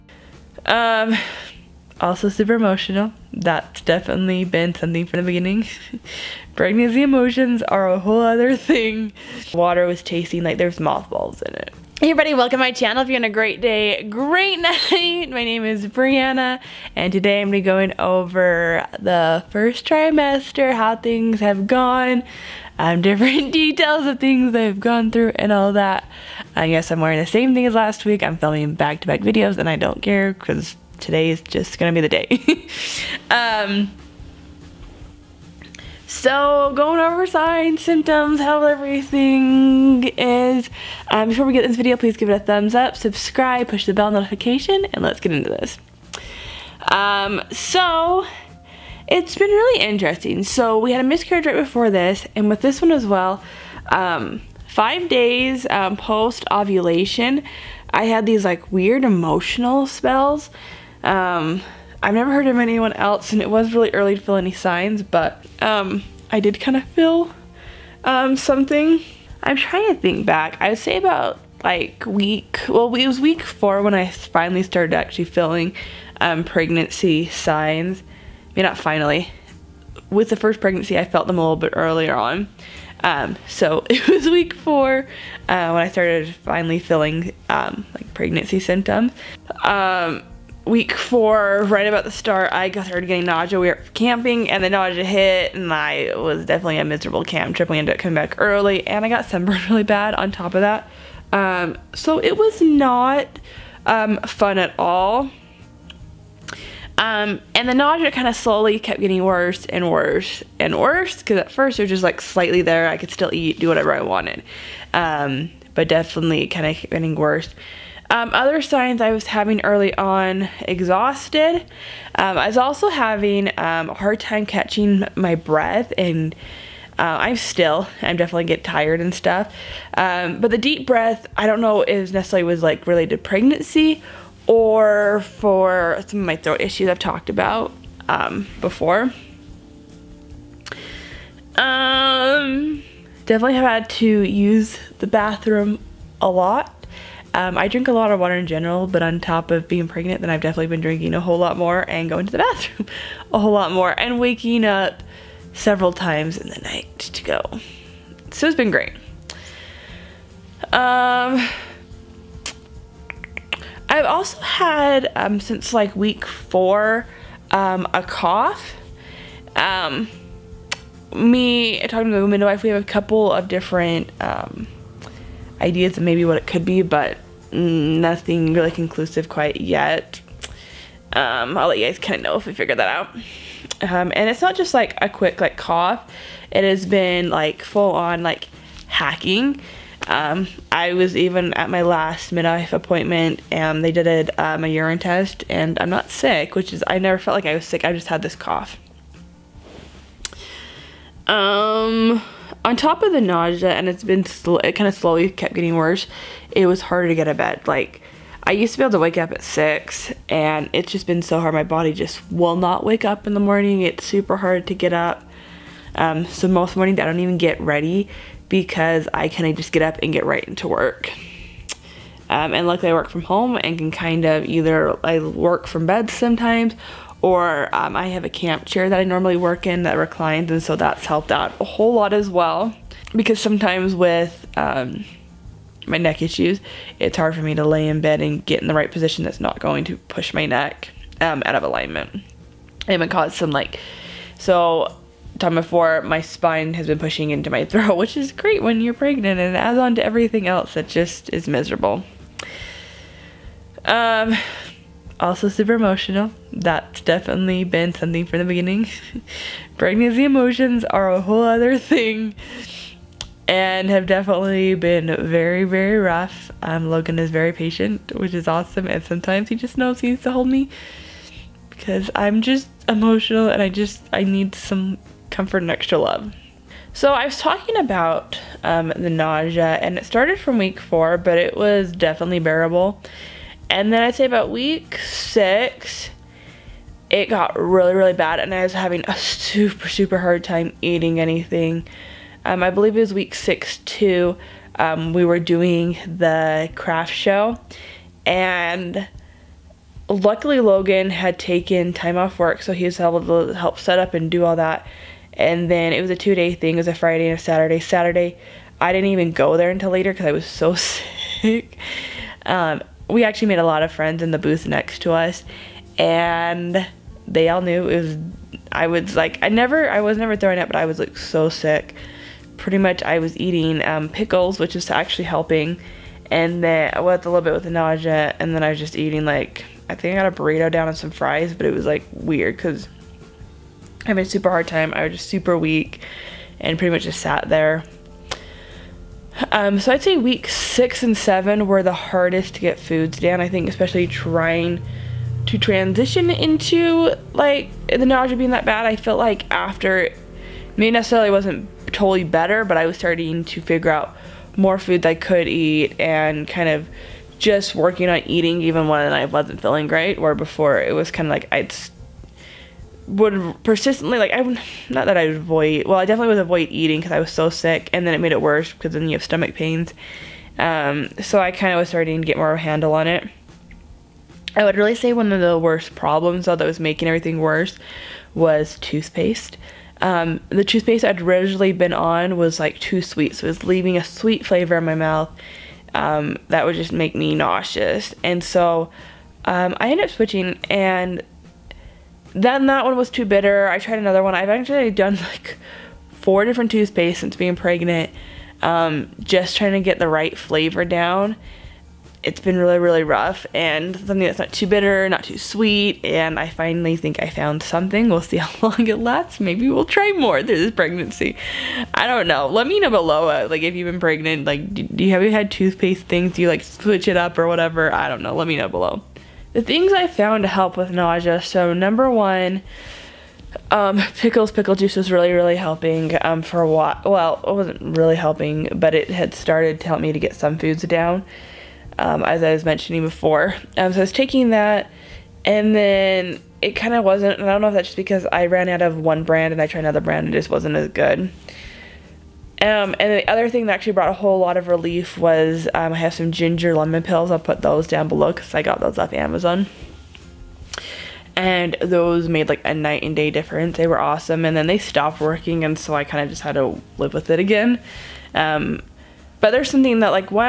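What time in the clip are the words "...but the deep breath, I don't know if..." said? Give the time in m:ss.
2:10.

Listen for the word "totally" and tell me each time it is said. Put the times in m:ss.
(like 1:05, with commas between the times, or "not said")
5:51.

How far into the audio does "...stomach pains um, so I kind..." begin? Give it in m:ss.
6:09.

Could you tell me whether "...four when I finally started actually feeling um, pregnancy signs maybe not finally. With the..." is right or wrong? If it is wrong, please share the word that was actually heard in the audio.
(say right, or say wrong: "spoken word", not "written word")
right.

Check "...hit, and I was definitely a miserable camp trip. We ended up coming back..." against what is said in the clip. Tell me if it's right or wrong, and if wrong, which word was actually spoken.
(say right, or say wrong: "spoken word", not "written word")
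right.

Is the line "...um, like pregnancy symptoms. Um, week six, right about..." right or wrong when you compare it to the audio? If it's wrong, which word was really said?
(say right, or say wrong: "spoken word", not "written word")
wrong: "four", not "six".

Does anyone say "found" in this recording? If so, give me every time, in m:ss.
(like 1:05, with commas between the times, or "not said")
6:47, 7:00.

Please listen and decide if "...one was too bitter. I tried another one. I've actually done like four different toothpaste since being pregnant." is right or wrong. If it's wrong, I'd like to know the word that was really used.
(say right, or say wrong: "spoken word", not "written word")
right.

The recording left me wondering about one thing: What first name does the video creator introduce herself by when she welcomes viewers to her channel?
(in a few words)
Brianna.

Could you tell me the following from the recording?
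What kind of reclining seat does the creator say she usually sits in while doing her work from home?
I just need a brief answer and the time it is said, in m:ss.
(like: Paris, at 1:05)
Camp chair, at 3:48.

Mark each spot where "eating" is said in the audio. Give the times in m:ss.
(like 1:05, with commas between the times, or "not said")
4:50, 5:23, 5:28, 5:58, 6:06.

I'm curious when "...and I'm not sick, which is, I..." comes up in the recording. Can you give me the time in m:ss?
3:15.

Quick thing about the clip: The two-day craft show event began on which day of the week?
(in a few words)
Friday.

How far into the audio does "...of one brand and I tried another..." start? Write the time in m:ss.
7:18.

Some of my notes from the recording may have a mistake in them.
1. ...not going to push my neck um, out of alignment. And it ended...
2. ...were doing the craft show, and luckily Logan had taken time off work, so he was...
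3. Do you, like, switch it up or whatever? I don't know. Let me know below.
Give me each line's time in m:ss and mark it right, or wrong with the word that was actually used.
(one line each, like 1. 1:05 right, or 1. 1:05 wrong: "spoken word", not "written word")
1. 3:59 wrong: "caused", not "ended"
2. 4:55 right
3. 6:56 right.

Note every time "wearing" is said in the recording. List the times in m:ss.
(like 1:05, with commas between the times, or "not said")
0:26.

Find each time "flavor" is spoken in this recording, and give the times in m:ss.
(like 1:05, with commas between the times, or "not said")
6:24, 6:40.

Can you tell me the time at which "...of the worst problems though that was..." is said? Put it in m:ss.
6:15.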